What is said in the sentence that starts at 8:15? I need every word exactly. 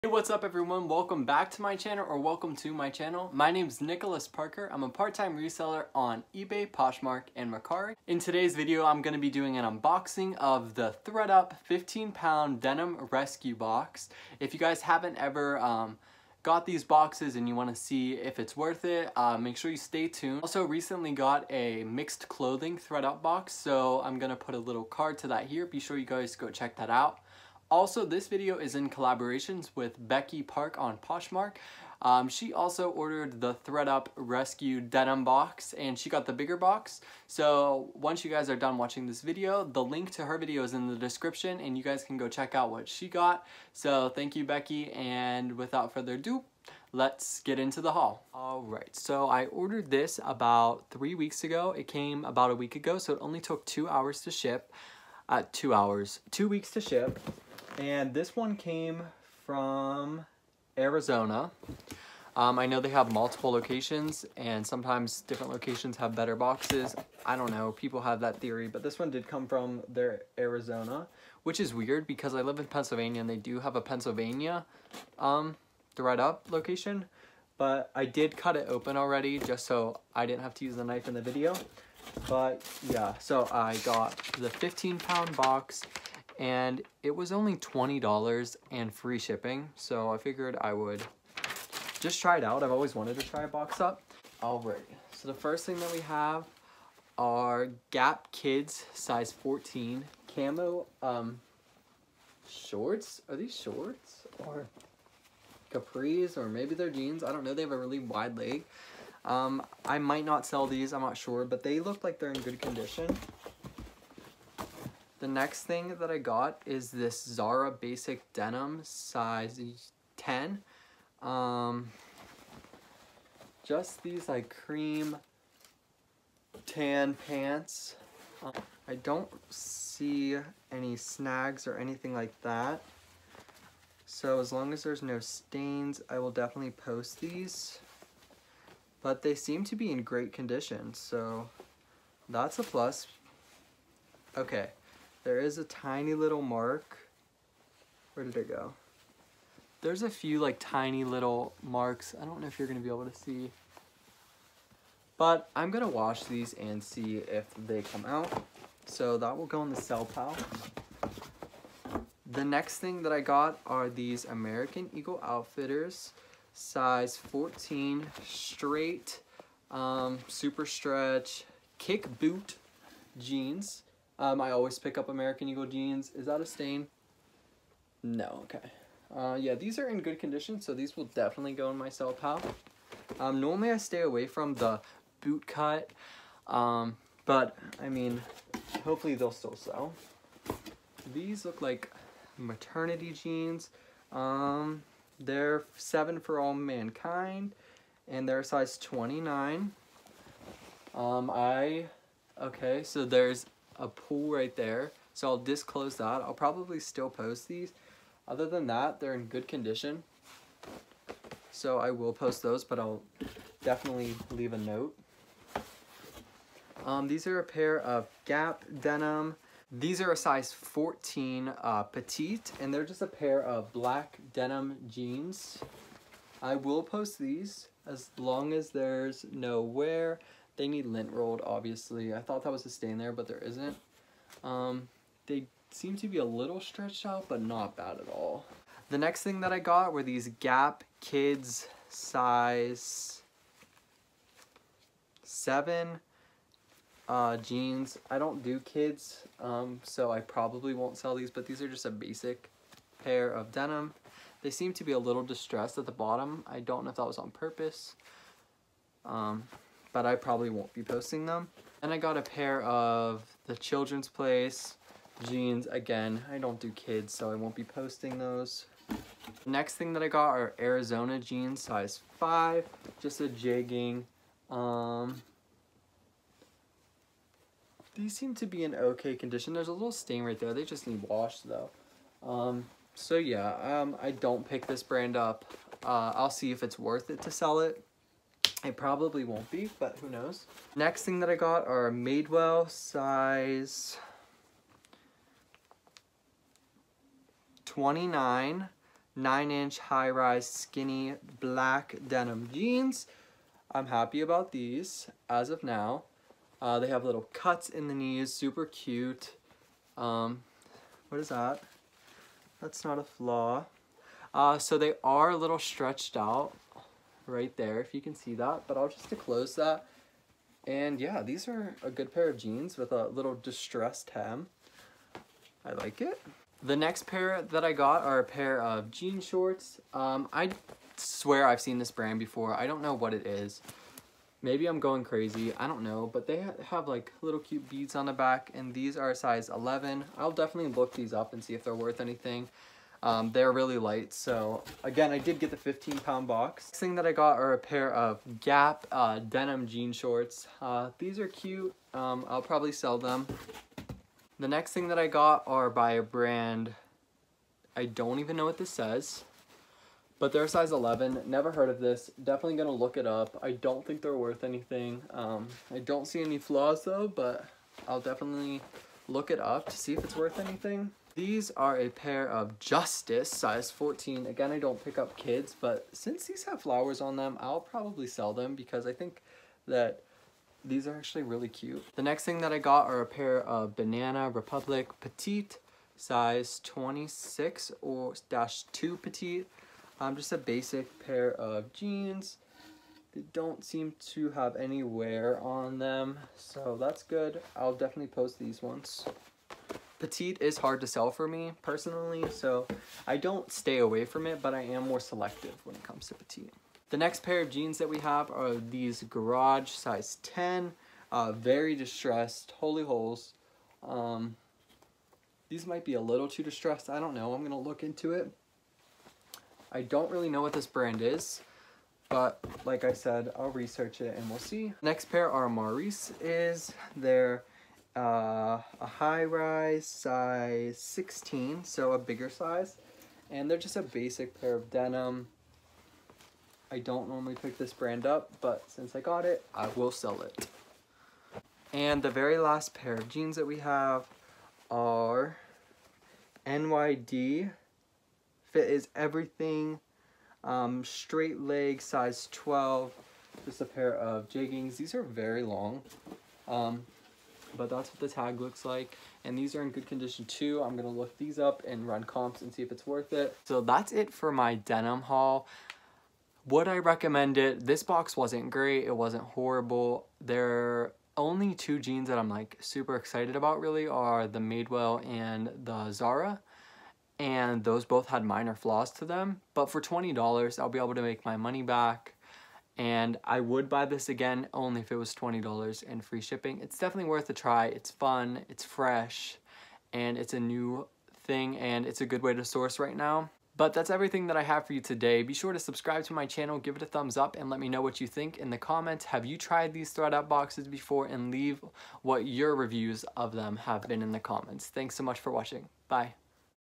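Be sure to subscribe to my channel, give it a thumbs up, and let me know what you think in the comments.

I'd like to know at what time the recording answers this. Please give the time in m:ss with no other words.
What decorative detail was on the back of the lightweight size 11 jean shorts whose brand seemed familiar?
5:37.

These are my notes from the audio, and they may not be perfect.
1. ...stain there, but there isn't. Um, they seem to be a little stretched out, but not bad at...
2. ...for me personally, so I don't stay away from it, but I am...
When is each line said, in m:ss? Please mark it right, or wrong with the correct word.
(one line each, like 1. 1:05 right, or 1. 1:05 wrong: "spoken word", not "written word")
1. 3:52 right
2. 6:41 right.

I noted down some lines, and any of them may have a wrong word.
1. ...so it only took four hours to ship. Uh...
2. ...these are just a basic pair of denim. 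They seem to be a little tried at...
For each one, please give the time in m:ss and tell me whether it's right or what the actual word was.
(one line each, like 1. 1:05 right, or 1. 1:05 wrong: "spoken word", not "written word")
1. 0:52 wrong: "two", not "four"
2. 4:11 wrong: "distressed", not "tried".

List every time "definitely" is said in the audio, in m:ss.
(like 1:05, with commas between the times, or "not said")
2:16, 3:01, 3:33, 5:40, 6:02, 6:07, 6:37, 8:06.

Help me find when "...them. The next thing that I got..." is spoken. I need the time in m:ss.
5:52.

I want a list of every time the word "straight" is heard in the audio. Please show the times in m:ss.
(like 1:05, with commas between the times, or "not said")
2:48, 7:30.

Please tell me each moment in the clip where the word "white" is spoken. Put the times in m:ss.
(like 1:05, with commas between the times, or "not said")
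not said.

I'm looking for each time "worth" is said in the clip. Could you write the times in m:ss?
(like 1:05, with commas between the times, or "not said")
0:18, 4:46, 5:41, 6:04, 6:10, 7:42, 8:07.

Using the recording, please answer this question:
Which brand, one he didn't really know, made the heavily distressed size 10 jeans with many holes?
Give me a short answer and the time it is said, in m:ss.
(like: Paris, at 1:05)
Garage, at 6:49.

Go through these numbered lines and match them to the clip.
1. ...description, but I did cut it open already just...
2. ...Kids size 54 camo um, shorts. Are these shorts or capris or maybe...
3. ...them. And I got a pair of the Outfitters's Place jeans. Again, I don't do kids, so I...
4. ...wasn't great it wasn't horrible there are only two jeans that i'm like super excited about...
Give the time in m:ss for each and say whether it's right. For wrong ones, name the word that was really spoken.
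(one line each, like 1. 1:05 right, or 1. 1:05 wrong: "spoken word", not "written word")
1. 1:16 wrong: "location", not "description"
2. 1:38 wrong: "14", not "54"
3. 4:21 wrong: "Children", not "Outfitters"
4. 7:48 right.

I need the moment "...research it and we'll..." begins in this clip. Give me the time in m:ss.
7:03.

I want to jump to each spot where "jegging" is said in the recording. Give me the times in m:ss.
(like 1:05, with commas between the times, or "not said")
4:33, 7:34.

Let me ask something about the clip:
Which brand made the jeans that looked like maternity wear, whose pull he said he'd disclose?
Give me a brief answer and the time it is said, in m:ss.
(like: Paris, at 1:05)
7 for All Mankind, at 3:15.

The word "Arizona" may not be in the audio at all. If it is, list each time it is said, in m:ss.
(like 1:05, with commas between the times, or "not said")
1:00, 1:10, 4:30.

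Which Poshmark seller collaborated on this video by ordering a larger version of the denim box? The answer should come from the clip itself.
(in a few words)
Becky Park.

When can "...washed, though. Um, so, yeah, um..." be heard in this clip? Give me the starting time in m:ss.
4:41.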